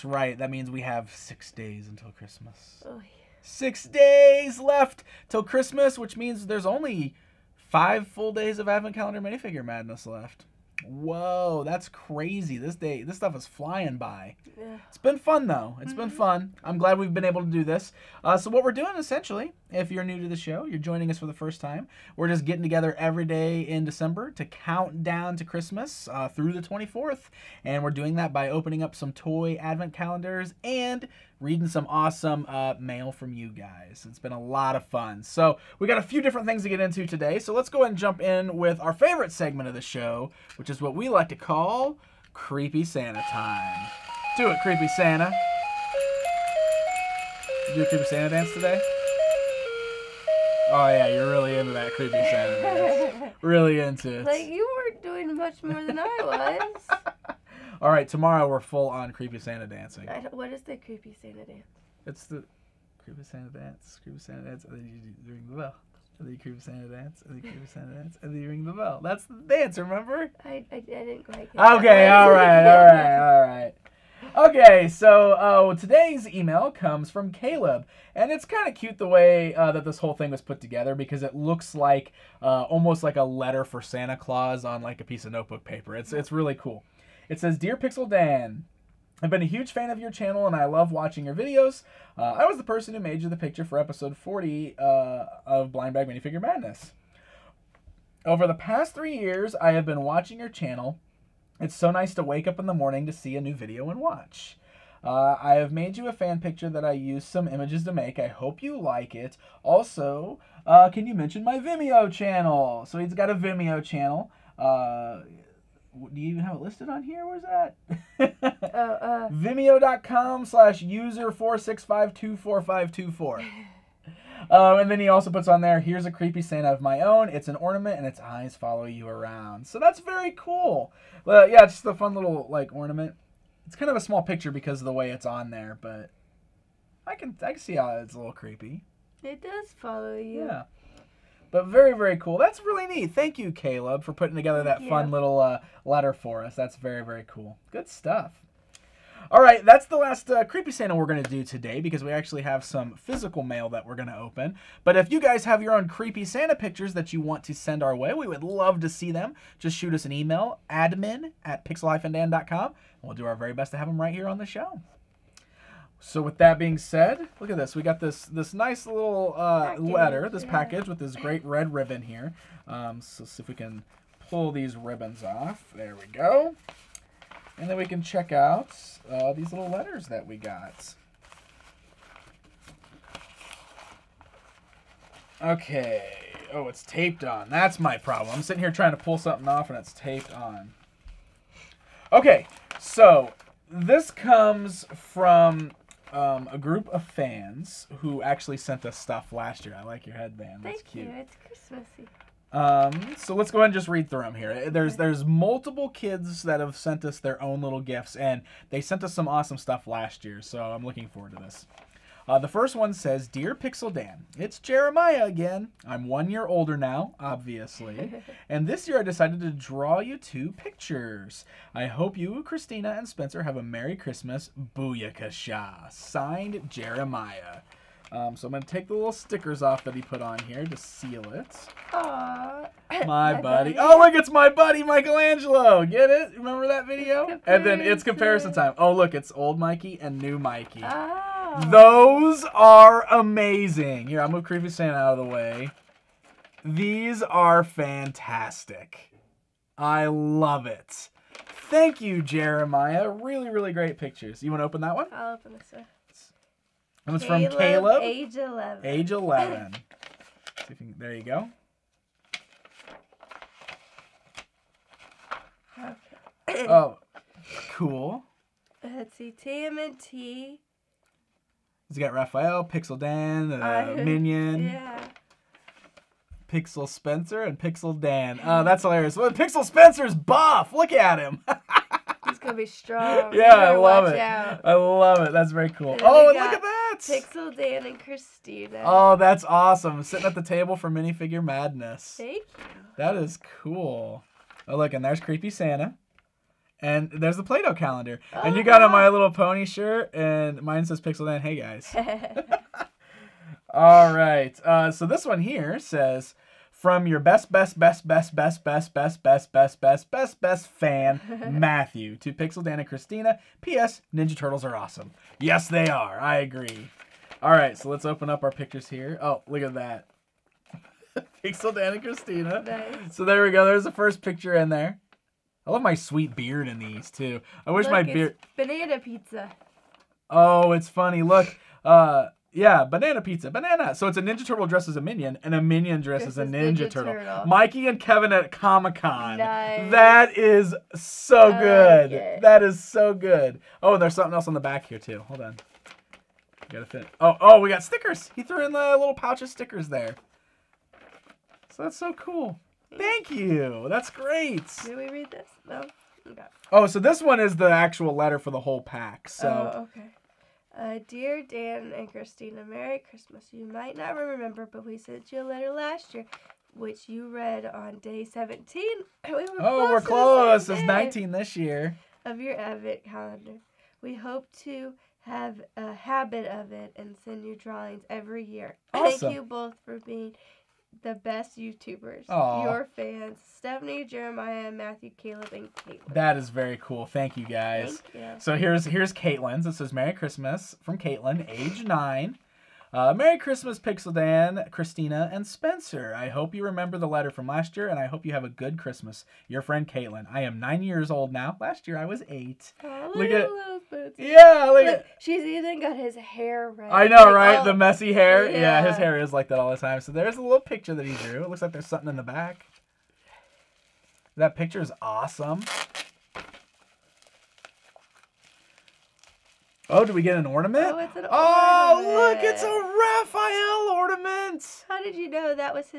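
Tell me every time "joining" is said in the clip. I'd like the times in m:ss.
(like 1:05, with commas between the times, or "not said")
0:20.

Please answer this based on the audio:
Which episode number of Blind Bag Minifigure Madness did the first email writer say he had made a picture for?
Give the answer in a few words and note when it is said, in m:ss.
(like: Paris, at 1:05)
40, at 1:33.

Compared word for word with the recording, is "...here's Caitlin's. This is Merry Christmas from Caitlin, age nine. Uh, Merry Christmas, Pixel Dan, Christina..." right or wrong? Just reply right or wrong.
right.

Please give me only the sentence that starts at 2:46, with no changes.
So with that being said, look at this.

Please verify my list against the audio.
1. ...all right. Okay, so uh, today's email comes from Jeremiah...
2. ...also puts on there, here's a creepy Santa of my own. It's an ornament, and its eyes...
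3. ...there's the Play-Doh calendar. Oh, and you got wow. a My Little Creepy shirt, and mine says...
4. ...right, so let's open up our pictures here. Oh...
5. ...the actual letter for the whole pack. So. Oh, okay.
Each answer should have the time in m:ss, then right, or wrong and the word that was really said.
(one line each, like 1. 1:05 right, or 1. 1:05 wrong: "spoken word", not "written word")
1. 1:13 wrong: "Caleb", not "Jeremiah"
2. 2:05 right
3. 4:57 wrong: "Pony", not "Creepy"
4. 5:17 right
5. 5:57 right.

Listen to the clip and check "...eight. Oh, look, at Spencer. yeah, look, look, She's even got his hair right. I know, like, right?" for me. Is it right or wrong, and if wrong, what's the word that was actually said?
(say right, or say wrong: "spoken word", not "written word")
right.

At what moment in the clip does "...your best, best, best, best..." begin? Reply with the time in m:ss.
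5:07.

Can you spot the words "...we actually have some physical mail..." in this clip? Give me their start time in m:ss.
2:32.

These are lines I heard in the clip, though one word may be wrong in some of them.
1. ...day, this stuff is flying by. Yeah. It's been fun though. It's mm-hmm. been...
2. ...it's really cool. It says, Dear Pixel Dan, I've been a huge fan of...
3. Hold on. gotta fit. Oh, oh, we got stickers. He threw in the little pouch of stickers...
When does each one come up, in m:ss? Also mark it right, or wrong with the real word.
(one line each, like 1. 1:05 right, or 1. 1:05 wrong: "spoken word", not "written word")
1. 0:12 right
2. 1:26 right
3. 5:45 right.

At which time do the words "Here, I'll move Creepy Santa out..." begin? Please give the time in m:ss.
4:04.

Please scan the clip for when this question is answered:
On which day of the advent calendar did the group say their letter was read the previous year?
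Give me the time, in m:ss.
6:08.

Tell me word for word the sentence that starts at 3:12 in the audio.
Okay, so this comes from um, a group of fans who actually sent us stuff last year.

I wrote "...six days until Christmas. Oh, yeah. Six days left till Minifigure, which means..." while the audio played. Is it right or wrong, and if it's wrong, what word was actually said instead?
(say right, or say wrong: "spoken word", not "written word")
wrong: "Christmas", not "Minifigure".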